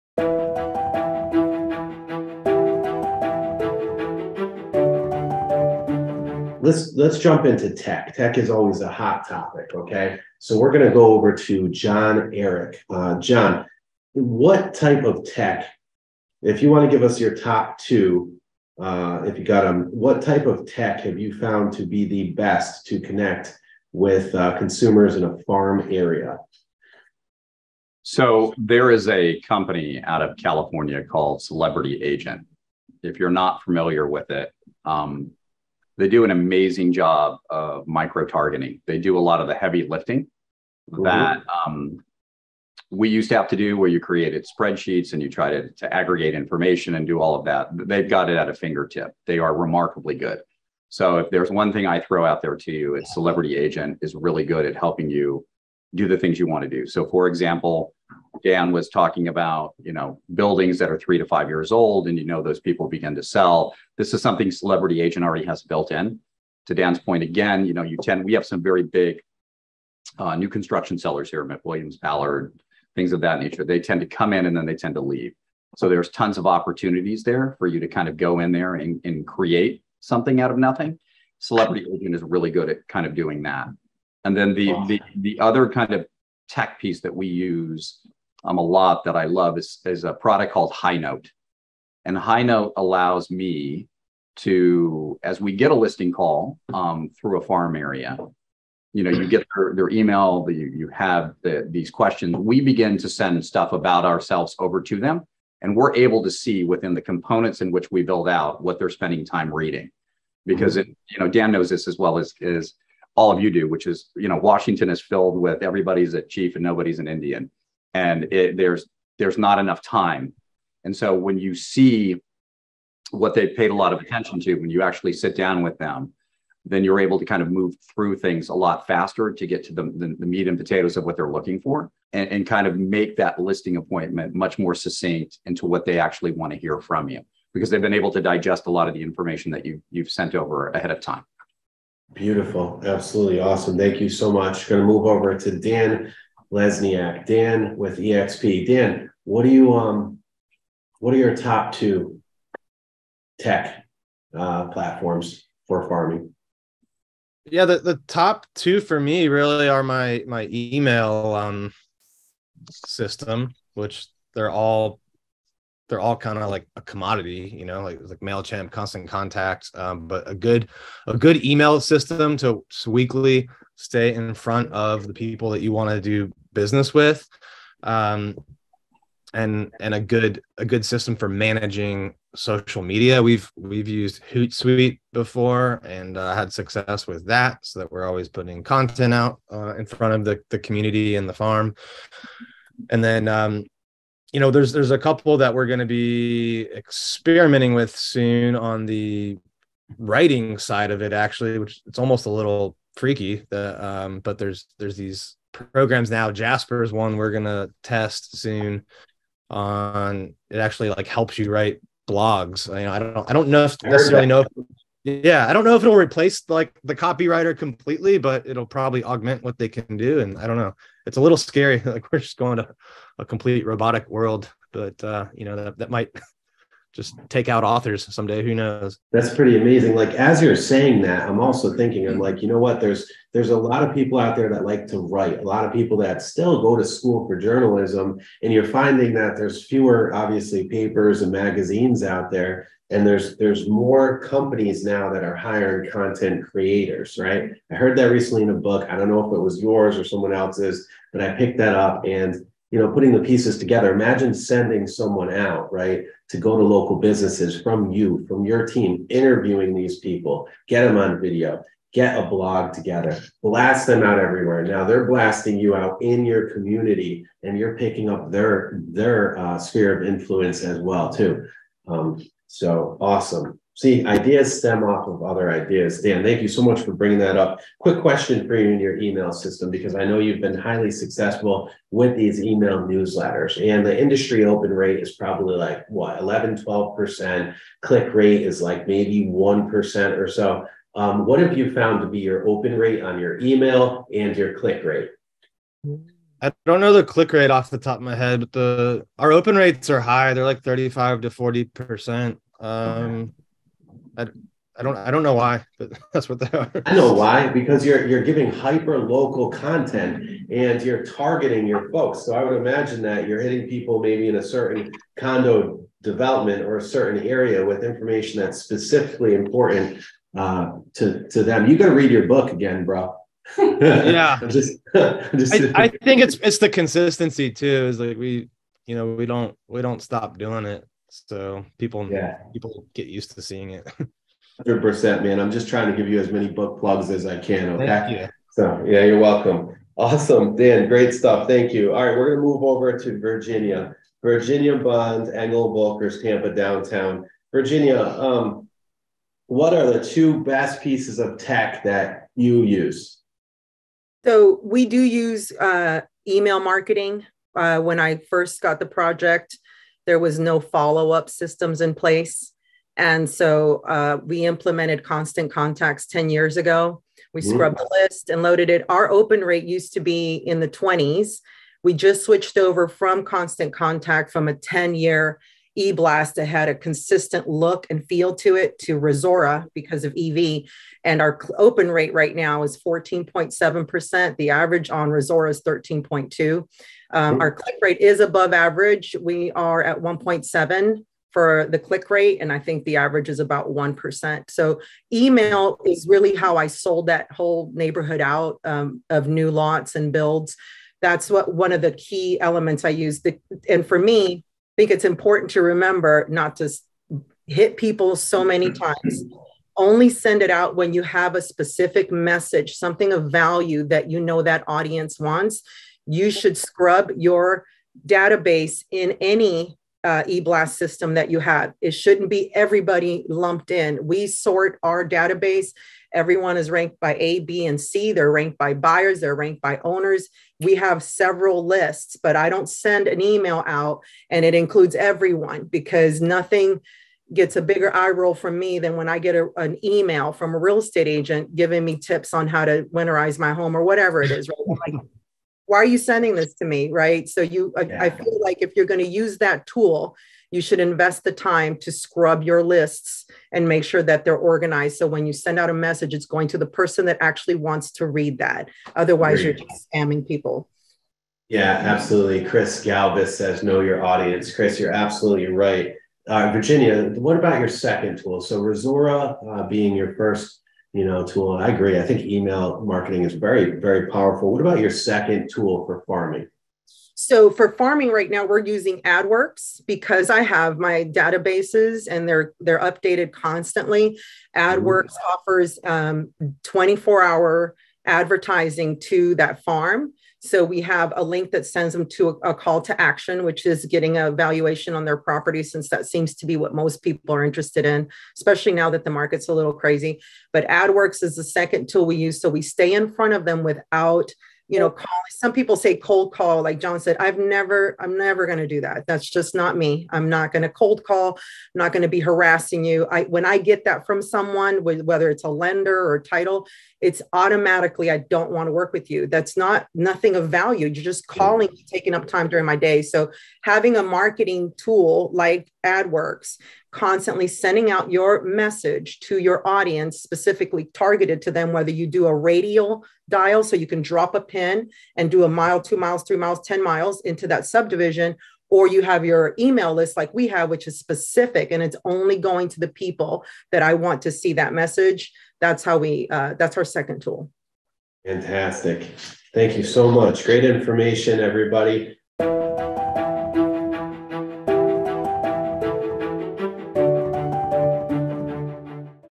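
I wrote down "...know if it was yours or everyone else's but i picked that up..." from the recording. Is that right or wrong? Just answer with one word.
wrong.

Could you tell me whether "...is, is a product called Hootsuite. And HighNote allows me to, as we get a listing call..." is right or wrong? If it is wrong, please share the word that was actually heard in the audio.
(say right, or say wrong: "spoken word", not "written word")
wrong: "HighNote", not "Hootsuite".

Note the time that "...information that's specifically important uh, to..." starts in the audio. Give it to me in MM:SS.
05:17.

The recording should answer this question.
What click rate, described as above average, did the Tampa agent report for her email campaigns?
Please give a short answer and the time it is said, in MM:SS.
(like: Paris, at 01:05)
1.7, at 06:29.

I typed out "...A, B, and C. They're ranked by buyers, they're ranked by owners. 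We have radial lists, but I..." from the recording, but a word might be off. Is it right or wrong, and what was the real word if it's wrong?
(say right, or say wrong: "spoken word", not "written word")
wrong: "several", not "radial".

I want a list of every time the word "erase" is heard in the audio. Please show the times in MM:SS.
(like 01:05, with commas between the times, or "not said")
not said.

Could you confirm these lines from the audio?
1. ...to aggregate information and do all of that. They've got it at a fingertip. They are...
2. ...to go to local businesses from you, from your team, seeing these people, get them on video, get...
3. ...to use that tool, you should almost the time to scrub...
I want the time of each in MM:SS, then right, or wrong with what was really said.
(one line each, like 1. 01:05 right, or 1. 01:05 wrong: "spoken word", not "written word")
1. 00:45 right
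2. 04:16 wrong: "interviewing", not "seeing"
3. 07:28 wrong: "invest", not "almost".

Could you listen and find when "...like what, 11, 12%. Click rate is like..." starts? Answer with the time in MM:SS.
04:45.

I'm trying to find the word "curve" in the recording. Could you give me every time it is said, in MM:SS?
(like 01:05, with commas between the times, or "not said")
not said.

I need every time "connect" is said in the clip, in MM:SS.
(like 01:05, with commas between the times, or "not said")
00:22.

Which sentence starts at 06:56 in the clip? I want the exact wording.
You should scrub your database in any uh, eblast system that you have.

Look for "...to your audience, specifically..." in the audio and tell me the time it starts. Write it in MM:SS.
08:49.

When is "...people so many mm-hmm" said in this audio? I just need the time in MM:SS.
06:47.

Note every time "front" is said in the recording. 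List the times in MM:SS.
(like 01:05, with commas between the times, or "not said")
02:54, 03:09, 08:23.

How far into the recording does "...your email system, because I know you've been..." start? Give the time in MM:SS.
04:38.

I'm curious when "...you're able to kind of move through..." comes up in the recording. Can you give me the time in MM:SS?
02:06.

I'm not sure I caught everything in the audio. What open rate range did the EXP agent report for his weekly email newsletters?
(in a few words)
35 to 40 percent.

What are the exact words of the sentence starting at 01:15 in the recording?
So there's tons of opportunities there for you to kind of go in there and, and create something out of nothing.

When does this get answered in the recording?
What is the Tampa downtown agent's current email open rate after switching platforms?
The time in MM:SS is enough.
06:22.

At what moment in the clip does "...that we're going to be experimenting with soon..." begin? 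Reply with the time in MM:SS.
03:15.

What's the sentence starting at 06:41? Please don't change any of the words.
That's what one of the key elements I use.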